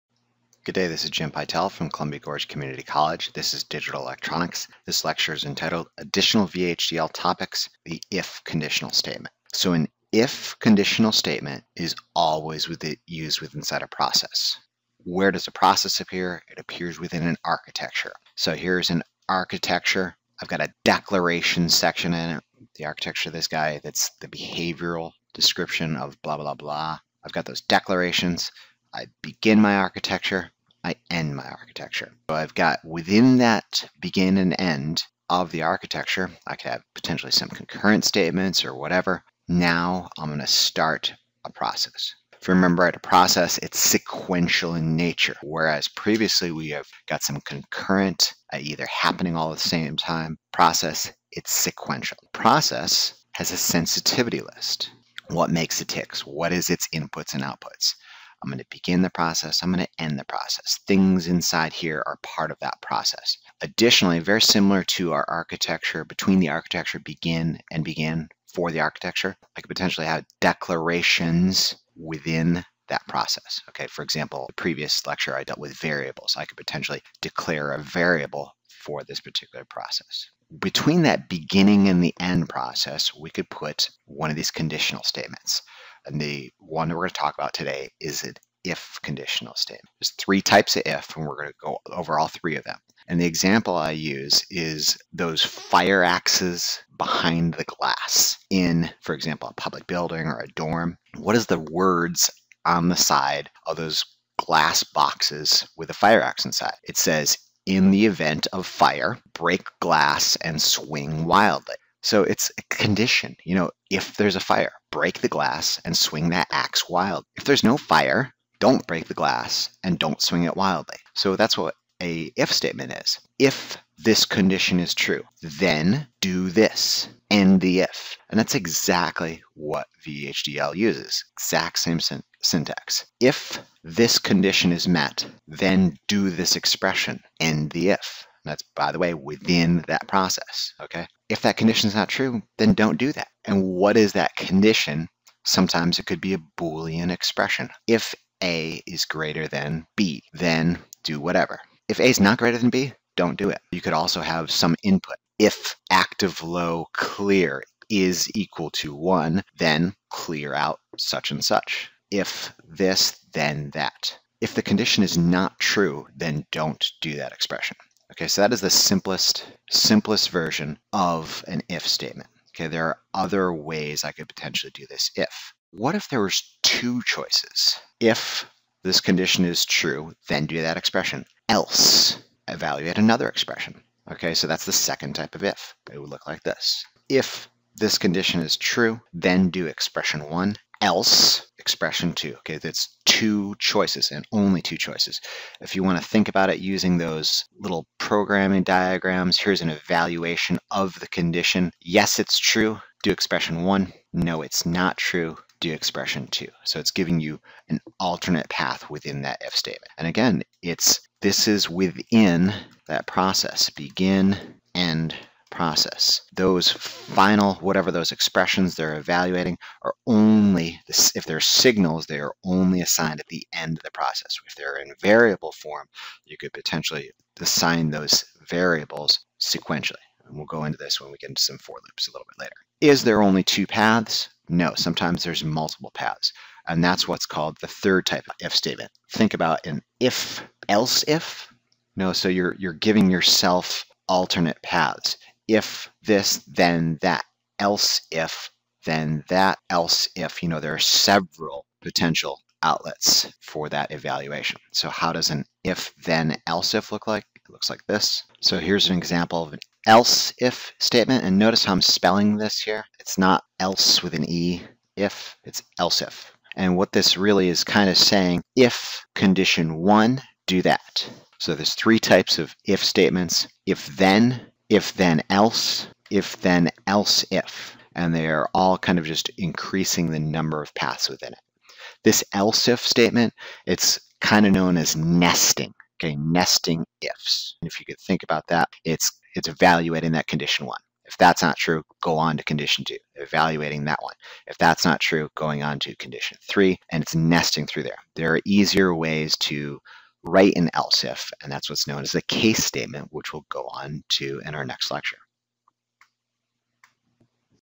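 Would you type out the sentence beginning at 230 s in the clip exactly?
And we'll go into this when we get into some for loops a little bit later.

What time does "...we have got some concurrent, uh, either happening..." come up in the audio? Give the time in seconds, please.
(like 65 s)
46 s.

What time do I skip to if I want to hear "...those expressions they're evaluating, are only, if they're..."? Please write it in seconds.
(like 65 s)
217 s.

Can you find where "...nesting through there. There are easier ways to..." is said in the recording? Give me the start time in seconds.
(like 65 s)
297 s.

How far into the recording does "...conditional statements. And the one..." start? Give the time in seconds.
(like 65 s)
84 s.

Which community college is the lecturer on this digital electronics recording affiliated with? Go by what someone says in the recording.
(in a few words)
Columbia Gorge Community College.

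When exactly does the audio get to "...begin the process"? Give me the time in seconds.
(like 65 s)
58 s.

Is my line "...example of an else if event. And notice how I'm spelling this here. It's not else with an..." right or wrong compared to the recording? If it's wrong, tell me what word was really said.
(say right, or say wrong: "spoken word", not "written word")
wrong: "statement", not "event".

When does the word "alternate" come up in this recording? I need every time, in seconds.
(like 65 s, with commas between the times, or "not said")
207 s, 244 s.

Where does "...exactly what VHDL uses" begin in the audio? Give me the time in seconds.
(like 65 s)
128 s.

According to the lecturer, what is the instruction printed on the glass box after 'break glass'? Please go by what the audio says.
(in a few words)
Swing wildly.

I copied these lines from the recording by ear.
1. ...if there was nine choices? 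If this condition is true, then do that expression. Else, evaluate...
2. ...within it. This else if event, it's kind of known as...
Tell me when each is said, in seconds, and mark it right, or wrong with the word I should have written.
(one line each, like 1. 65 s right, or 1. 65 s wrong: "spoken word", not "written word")
1. 175 s wrong: "two", not "nine"
2. 281 s wrong: "statement", not "event".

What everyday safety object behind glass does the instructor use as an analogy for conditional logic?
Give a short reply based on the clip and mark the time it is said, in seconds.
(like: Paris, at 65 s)
Fire axes, at 95 s.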